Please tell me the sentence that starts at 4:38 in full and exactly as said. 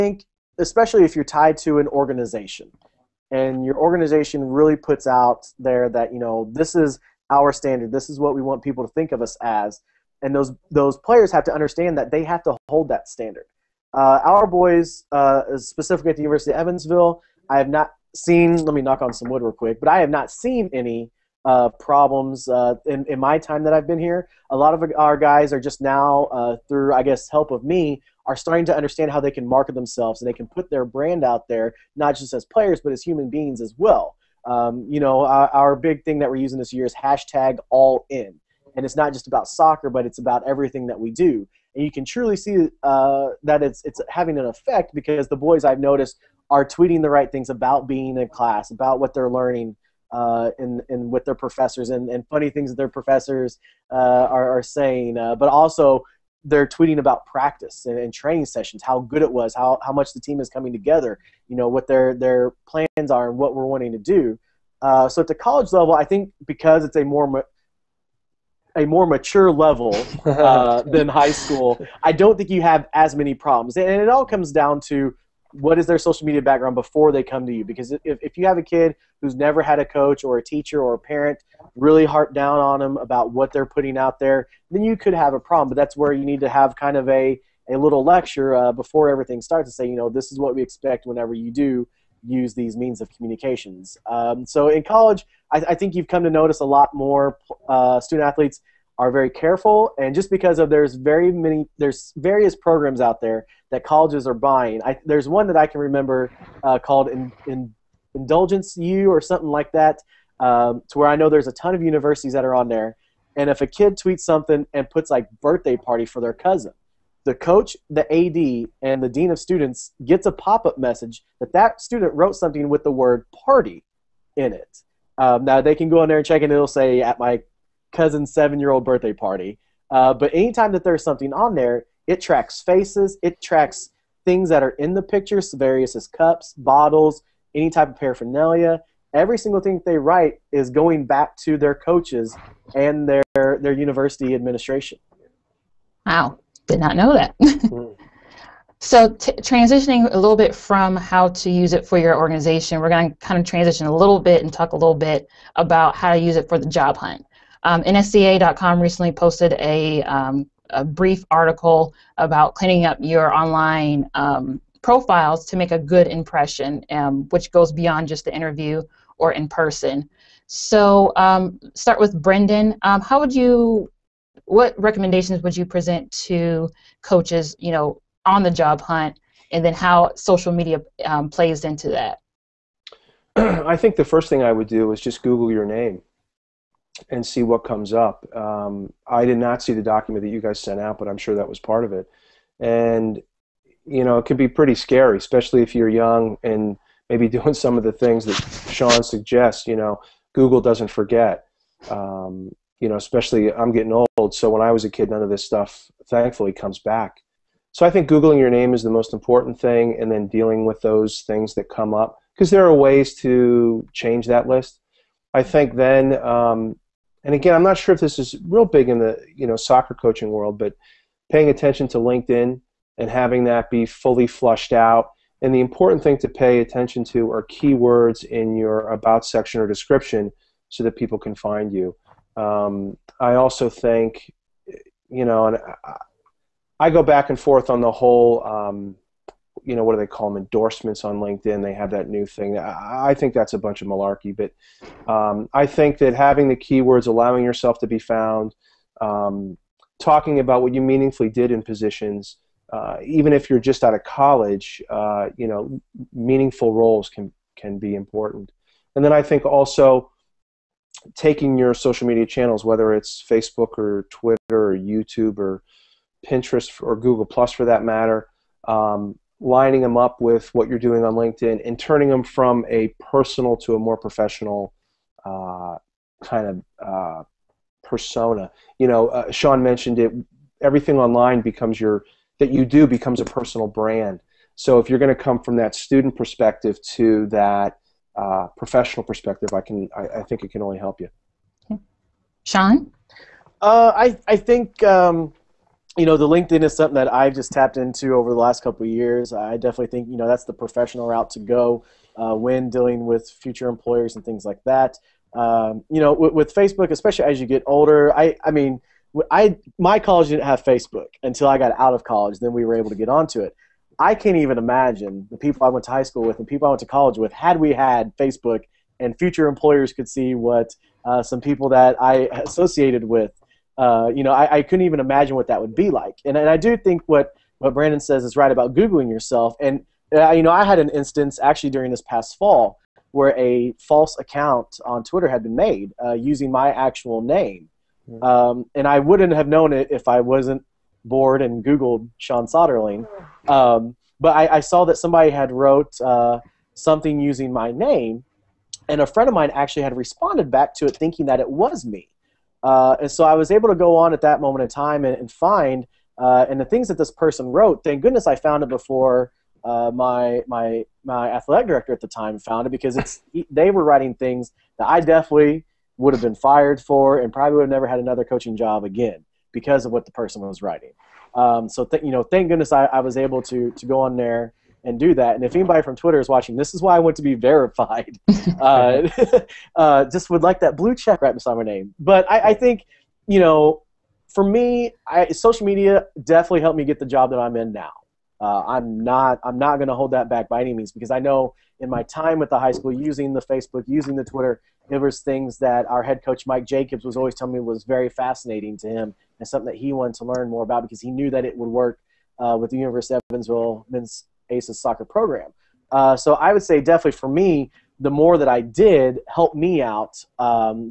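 You know, uh, Shaun mentioned it.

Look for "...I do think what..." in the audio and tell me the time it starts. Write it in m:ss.
5:26.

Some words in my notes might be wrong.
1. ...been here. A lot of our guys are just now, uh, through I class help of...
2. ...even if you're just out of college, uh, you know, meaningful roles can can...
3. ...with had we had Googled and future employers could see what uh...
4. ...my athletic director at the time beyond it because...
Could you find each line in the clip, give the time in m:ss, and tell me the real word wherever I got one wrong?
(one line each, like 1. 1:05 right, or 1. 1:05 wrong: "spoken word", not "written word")
1. 0:23 wrong: "guess", not "class"
2. 4:13 right
3. 5:17 wrong: "Facebook", not "Googled"
4. 6:01 wrong: "found", not "beyond".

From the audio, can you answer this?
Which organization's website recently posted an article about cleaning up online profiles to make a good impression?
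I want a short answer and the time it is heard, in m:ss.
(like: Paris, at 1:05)
NSCA.com, at 2:37.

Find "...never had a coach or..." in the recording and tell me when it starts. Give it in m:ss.
1:19.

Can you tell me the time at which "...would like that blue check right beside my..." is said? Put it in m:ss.
6:20.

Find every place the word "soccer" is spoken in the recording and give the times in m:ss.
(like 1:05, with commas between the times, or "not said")
0:39, 3:39, 6:44.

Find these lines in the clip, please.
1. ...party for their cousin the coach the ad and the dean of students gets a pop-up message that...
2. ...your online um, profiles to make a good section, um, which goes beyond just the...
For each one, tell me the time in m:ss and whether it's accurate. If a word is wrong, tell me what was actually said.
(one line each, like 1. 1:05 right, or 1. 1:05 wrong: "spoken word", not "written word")
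1. 1:55 right
2. 2:42 wrong: "impression", not "section".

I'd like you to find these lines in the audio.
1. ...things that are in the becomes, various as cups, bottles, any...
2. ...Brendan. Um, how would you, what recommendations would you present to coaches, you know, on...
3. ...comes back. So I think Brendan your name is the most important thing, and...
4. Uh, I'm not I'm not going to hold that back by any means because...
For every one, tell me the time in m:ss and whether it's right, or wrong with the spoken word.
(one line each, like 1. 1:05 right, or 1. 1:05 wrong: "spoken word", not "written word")
1. 2:14 wrong: "pictures", not "becomes"
2. 2:52 right
3. 3:26 wrong: "Googling", not "Brendan"
4. 6:28 right.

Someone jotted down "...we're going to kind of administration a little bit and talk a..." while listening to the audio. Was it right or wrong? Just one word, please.
wrong.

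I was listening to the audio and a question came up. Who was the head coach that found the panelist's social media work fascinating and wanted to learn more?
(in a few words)
Mike Jacobs.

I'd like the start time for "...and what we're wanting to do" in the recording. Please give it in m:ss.
1:03.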